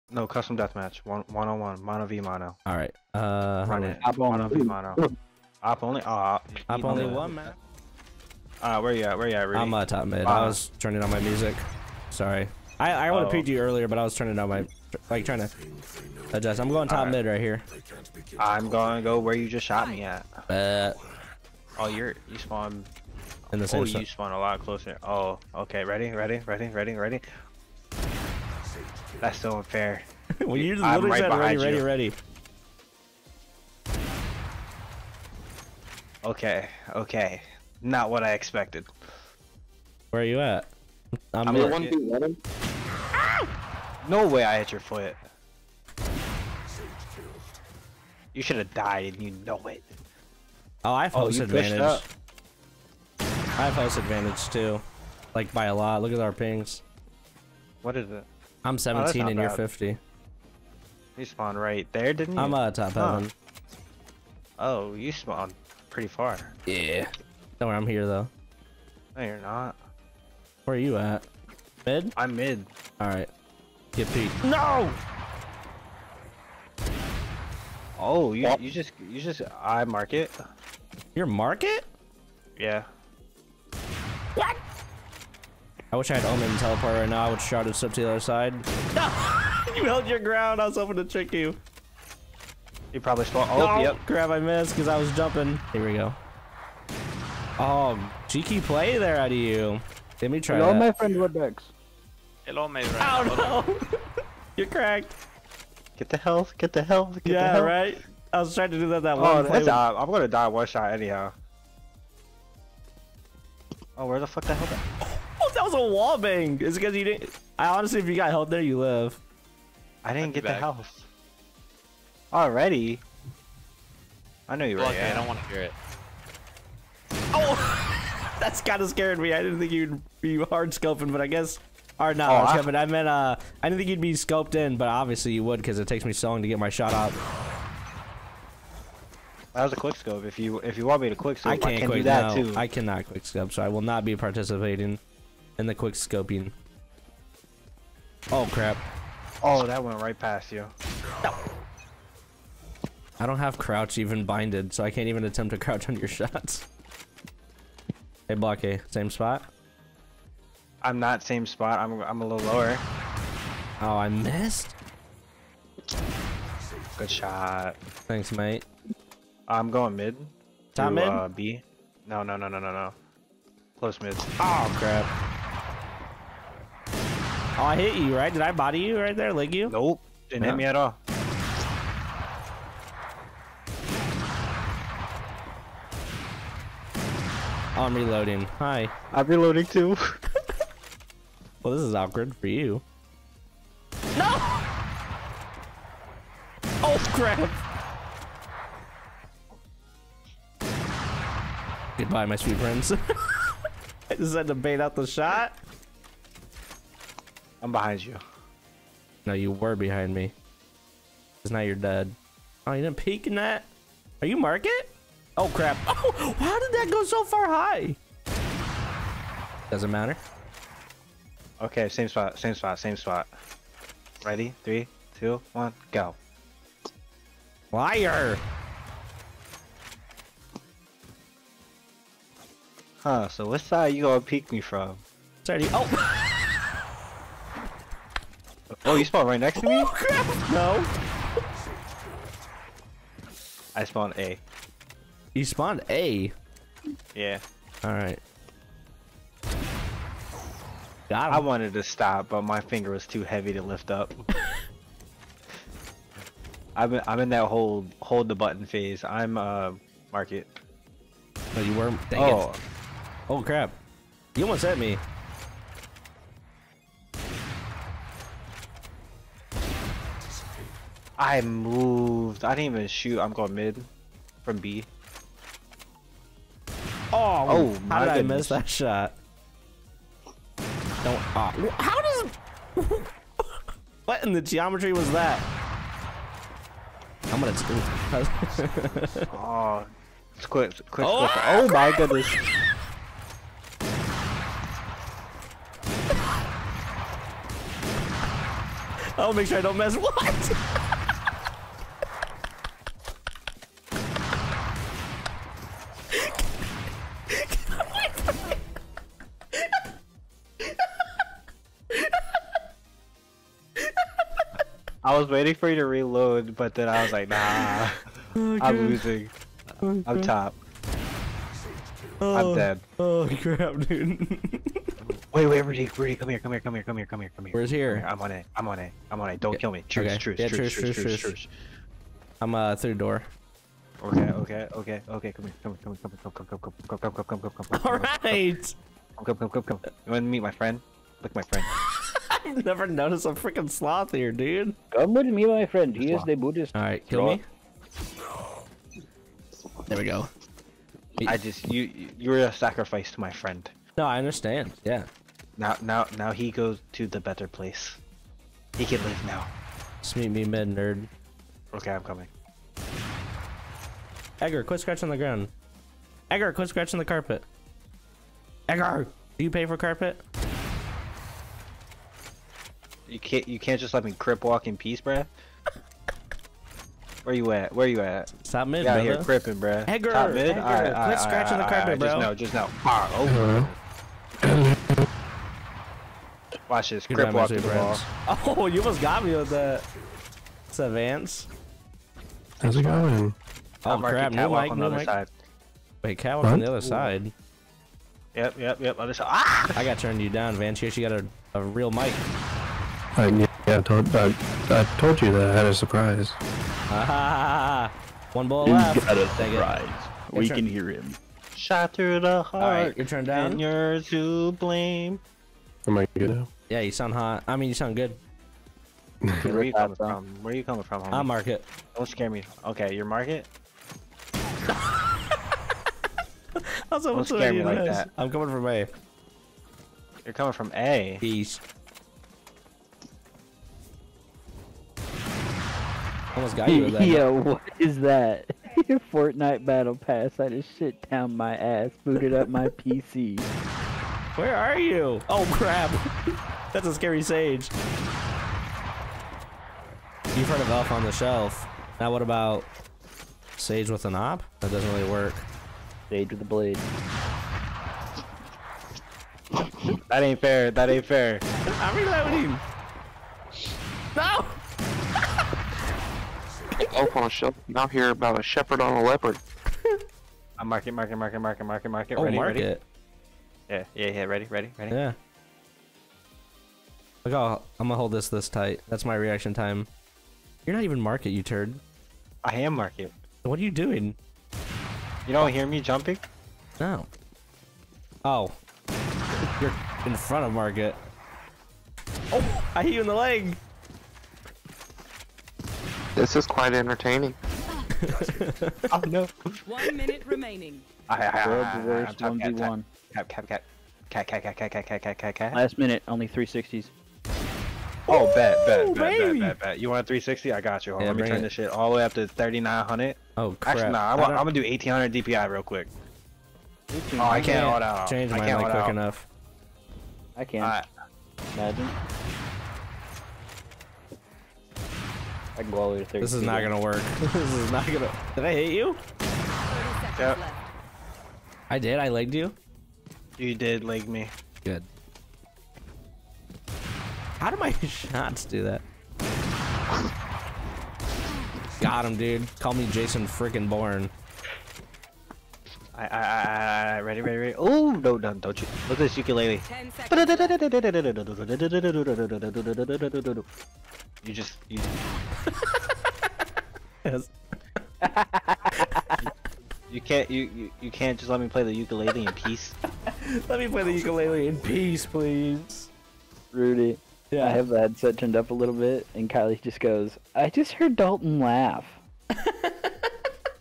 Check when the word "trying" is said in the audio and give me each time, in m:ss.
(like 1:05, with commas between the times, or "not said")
0:15, 1:48.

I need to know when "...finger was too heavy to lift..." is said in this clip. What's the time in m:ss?
4:12.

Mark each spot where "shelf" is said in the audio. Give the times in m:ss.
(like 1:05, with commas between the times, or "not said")
7:31, 7:47.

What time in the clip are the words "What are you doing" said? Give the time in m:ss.
8:03.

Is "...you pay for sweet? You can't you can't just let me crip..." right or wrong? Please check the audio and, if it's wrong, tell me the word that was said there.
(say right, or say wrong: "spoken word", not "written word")
wrong: "carpet", not "sweet".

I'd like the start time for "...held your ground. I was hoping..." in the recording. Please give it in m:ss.
1:29.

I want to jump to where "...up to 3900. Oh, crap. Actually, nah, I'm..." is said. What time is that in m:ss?
8:32.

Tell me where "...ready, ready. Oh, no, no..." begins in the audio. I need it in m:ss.
9:07.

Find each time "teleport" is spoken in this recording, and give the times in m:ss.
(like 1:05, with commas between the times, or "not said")
1:26.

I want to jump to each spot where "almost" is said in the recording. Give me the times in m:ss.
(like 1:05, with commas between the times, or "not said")
4:24, 6:28, 7:16.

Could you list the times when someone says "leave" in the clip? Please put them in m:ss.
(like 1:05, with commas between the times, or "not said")
5:59.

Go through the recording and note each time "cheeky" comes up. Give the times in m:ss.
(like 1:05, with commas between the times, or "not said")
1:38.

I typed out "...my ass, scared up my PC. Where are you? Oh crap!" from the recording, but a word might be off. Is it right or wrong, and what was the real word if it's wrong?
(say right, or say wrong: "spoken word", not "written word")
wrong: "booted", not "scared".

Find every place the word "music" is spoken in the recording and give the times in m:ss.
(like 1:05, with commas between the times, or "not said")
0:11.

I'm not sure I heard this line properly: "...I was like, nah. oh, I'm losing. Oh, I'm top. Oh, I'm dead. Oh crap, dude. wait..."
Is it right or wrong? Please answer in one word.
right.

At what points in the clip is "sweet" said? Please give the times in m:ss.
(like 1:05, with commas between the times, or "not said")
3:22.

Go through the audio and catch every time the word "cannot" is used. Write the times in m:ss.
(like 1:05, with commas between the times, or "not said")
2:22.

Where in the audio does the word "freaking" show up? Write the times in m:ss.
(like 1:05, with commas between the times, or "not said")
5:43, 9:03.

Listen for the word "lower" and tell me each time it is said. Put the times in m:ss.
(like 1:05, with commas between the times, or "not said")
2:42.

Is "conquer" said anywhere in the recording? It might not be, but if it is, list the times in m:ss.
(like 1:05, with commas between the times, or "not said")
not said.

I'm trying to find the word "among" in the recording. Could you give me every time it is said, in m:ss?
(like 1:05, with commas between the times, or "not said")
not said.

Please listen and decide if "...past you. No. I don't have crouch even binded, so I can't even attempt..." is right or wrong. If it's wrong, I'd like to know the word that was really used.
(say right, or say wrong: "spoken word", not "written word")
right.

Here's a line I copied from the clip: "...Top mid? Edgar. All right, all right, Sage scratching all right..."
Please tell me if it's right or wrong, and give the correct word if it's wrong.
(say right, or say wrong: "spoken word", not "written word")
wrong: "Quit", not "Sage".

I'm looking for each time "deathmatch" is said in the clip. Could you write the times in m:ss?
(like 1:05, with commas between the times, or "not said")
0:00.